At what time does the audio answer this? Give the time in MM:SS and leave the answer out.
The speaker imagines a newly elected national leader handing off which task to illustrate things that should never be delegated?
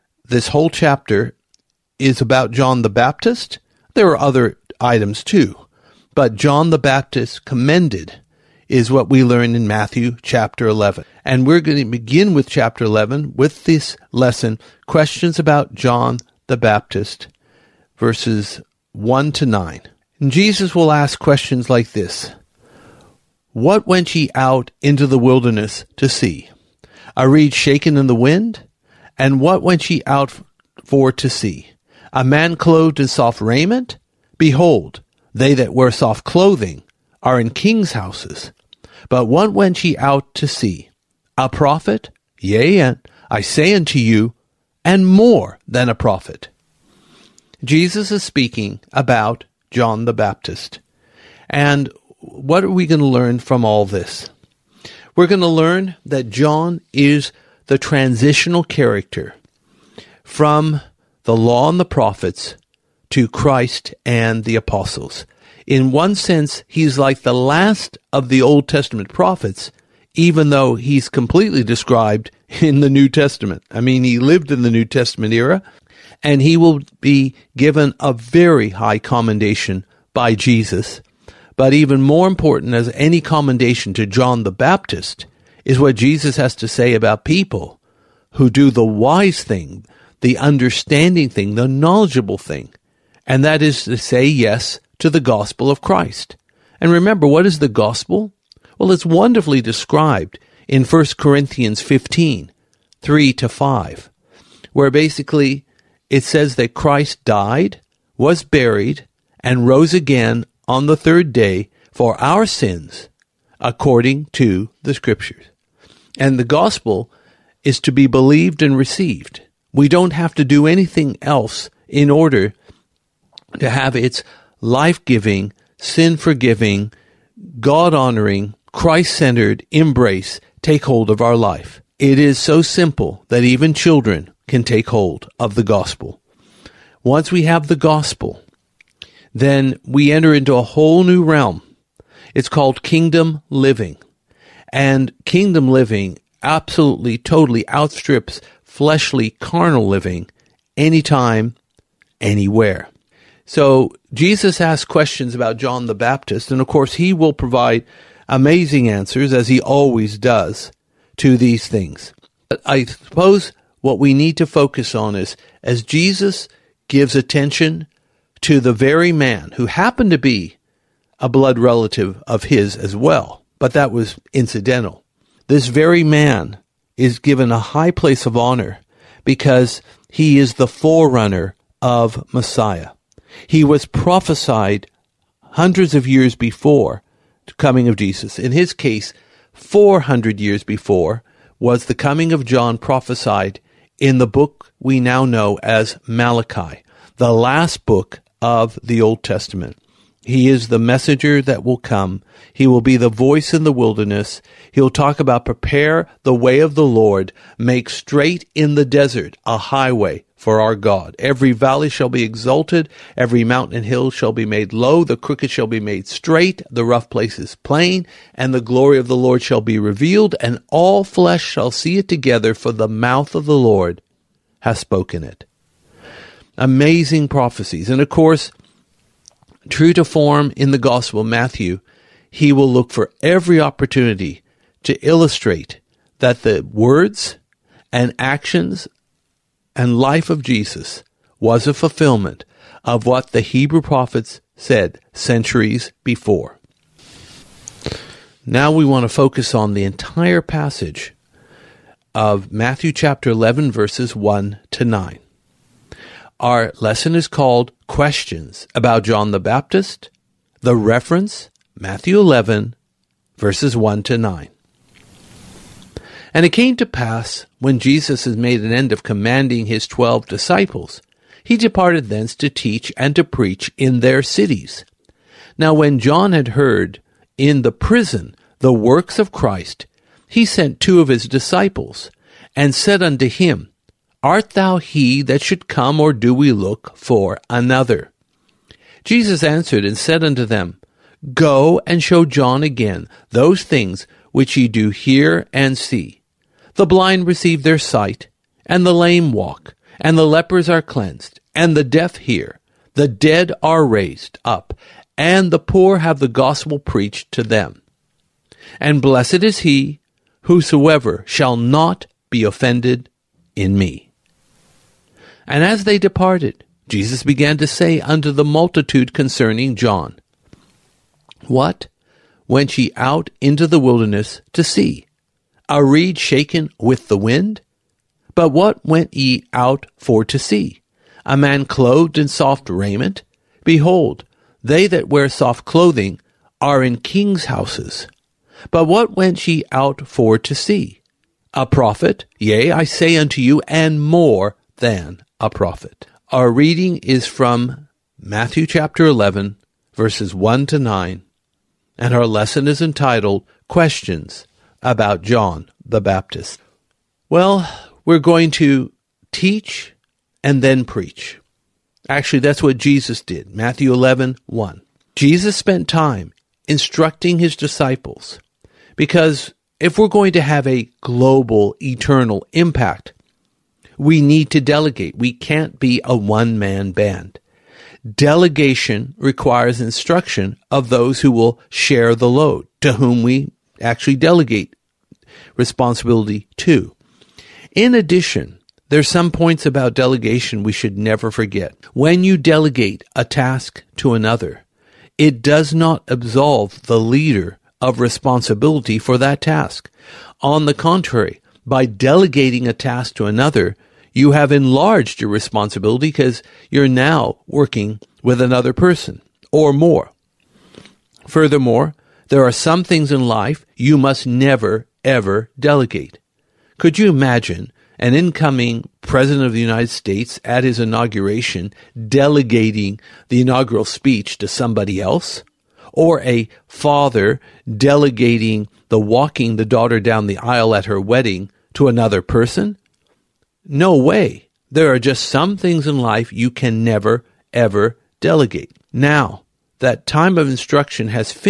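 07:03.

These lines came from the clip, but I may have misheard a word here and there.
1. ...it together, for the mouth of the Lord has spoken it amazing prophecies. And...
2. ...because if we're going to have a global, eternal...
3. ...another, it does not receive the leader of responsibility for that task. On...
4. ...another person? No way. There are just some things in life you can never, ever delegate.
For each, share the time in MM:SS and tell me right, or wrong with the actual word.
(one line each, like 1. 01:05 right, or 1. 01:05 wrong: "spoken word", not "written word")
1. 03:41 right
2. 06:08 right
3. 06:34 wrong: "absolve", not "receive"
4. 07:11 right.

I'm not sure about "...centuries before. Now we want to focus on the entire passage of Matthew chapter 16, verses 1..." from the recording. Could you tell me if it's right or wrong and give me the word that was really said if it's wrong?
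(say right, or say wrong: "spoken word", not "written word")
wrong: "11", not "16".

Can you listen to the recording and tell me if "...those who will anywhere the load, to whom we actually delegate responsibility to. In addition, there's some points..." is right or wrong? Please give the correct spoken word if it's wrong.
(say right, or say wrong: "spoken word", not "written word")
wrong: "share", not "anywhere".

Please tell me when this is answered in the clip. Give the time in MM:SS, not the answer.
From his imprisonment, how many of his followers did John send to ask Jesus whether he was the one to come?
04:40.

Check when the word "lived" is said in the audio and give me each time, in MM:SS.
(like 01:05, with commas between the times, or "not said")
01:14.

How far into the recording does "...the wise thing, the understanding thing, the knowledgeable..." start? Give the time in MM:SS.
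01:28.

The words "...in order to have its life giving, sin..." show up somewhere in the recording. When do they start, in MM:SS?
02:01.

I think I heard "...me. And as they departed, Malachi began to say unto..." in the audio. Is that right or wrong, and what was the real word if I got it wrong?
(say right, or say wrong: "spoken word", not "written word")
wrong: "Jesus", not "Malachi".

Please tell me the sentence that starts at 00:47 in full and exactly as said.
Jesus is speaking about John the Baptist.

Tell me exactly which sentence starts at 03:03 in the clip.
He was prophesied hundreds of years before the coming of Jesus.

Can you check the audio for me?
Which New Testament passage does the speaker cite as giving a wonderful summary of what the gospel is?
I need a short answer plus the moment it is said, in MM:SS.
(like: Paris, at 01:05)
1 Corinthians 15:3-5, at 01:40.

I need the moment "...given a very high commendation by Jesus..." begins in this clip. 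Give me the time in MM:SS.
01:17.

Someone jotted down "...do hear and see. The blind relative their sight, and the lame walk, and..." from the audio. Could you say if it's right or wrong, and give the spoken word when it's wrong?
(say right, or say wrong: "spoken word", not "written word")
wrong: "receive", not "relative".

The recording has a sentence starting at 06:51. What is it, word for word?
Furthermore, there are some things in life you must never, ever delegate.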